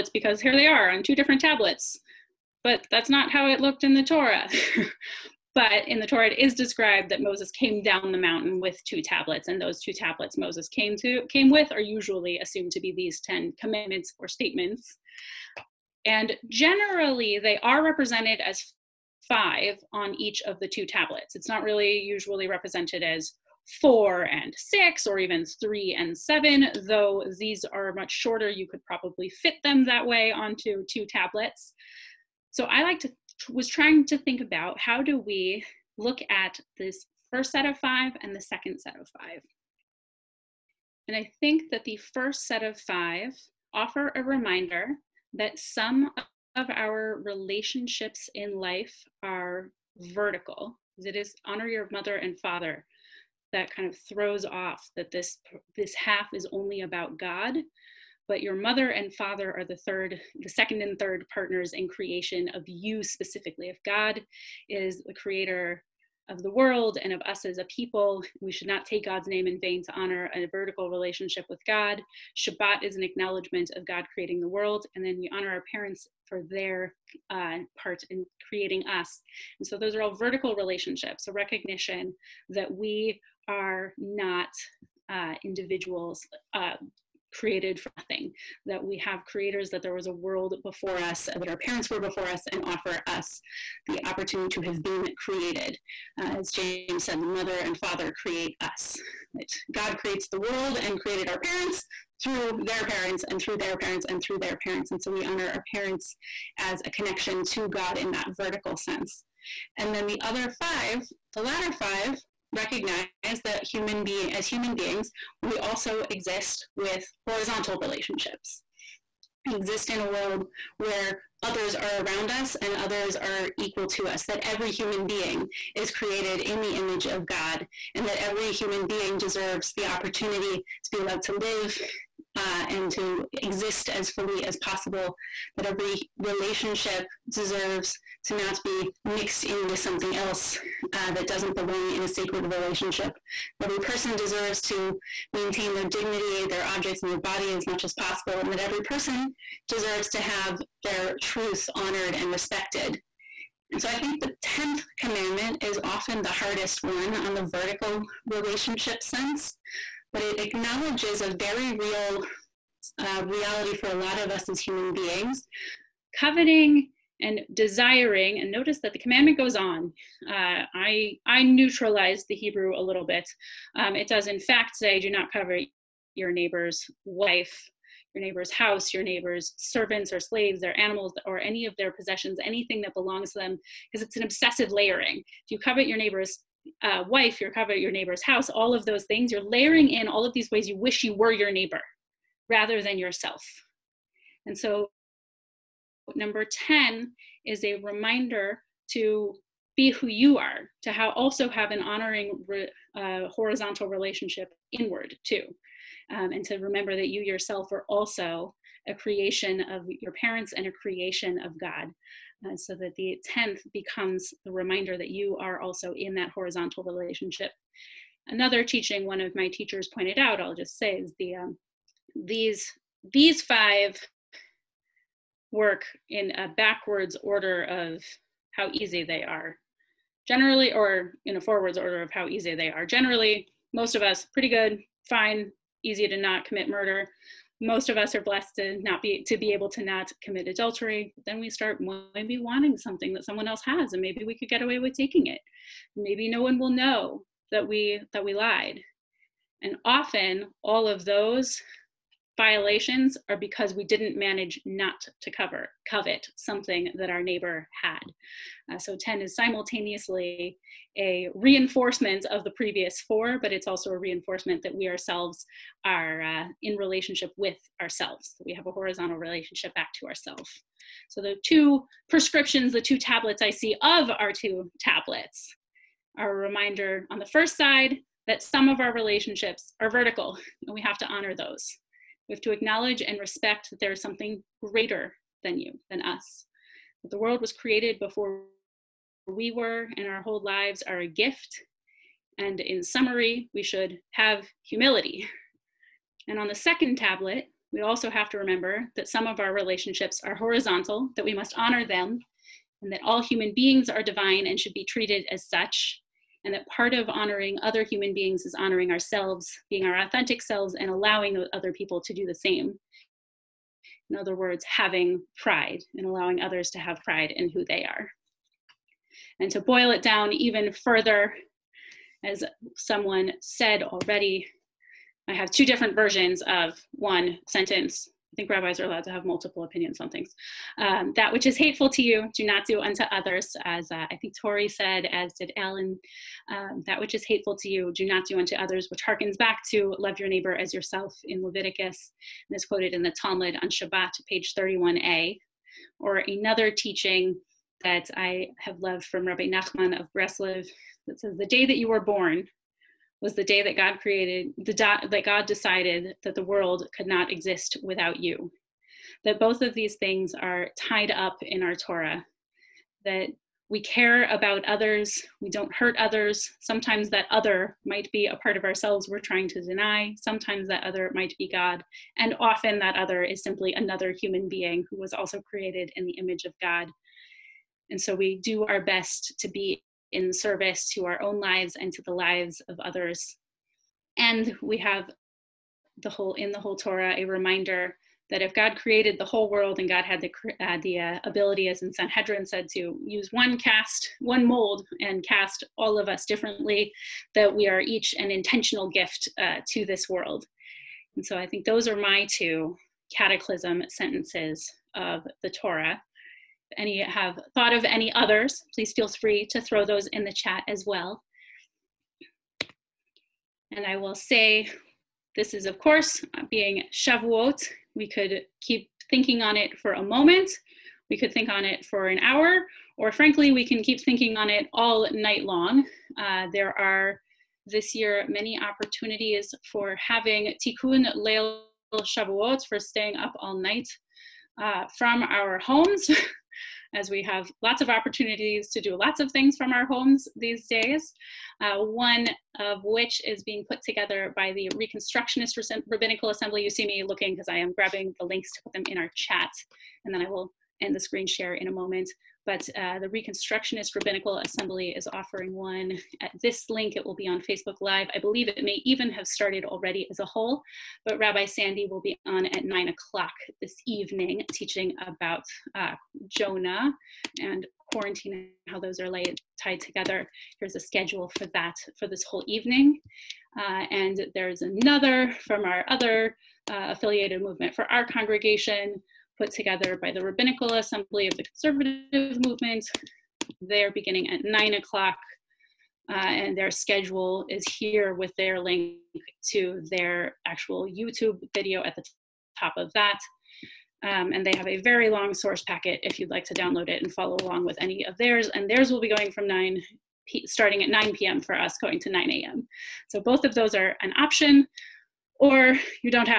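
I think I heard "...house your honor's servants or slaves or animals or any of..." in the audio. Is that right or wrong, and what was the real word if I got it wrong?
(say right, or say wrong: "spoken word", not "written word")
wrong: "neighbor", not "honor".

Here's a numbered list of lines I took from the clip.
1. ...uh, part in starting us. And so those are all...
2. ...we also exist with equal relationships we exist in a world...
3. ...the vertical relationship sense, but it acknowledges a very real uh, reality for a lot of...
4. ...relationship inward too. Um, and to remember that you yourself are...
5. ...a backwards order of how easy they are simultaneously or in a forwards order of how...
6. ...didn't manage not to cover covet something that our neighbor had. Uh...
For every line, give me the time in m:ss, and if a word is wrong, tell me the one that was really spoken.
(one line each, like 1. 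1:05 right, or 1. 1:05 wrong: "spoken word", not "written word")
1. 1:17 wrong: "creating", not "starting"
2. 1:55 wrong: "horizontal", not "equal"
3. 2:37 right
4. 3:23 right
5. 3:46 wrong: "generally", not "simultaneously"
6. 4:13 right.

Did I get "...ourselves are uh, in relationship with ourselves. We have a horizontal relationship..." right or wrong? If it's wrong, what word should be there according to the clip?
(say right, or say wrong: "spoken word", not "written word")
right.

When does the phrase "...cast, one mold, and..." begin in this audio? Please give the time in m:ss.
6:33.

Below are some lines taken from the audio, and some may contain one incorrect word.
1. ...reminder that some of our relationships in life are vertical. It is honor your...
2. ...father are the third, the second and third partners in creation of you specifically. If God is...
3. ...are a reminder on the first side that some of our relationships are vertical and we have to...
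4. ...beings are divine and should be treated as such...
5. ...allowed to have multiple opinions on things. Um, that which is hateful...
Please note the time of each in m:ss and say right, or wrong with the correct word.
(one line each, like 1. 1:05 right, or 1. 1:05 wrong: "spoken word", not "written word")
1. 0:44 right
2. 0:59 right
3. 4:36 right
4. 5:03 right
5. 5:28 right.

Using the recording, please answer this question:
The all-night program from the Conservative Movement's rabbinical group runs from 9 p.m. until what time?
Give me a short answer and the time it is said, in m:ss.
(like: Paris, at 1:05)
9 a.m., at 8:22.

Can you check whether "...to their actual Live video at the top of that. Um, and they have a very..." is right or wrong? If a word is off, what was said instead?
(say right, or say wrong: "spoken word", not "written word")
wrong: "YouTube", not "Live".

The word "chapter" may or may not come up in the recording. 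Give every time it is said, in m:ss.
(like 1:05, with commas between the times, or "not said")
not said.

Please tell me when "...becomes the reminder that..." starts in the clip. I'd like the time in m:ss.
3:33.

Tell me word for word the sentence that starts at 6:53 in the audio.
And I will say, this is of course being Shavuot.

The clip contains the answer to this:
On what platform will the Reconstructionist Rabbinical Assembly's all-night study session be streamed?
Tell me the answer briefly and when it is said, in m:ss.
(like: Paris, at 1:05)
Facebook Live, at 7:37.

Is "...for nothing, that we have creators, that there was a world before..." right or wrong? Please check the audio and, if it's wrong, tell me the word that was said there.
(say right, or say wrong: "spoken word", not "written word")
right.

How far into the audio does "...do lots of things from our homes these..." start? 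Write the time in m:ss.
7:18.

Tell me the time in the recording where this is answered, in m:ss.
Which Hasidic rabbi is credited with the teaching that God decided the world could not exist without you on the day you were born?
5:49.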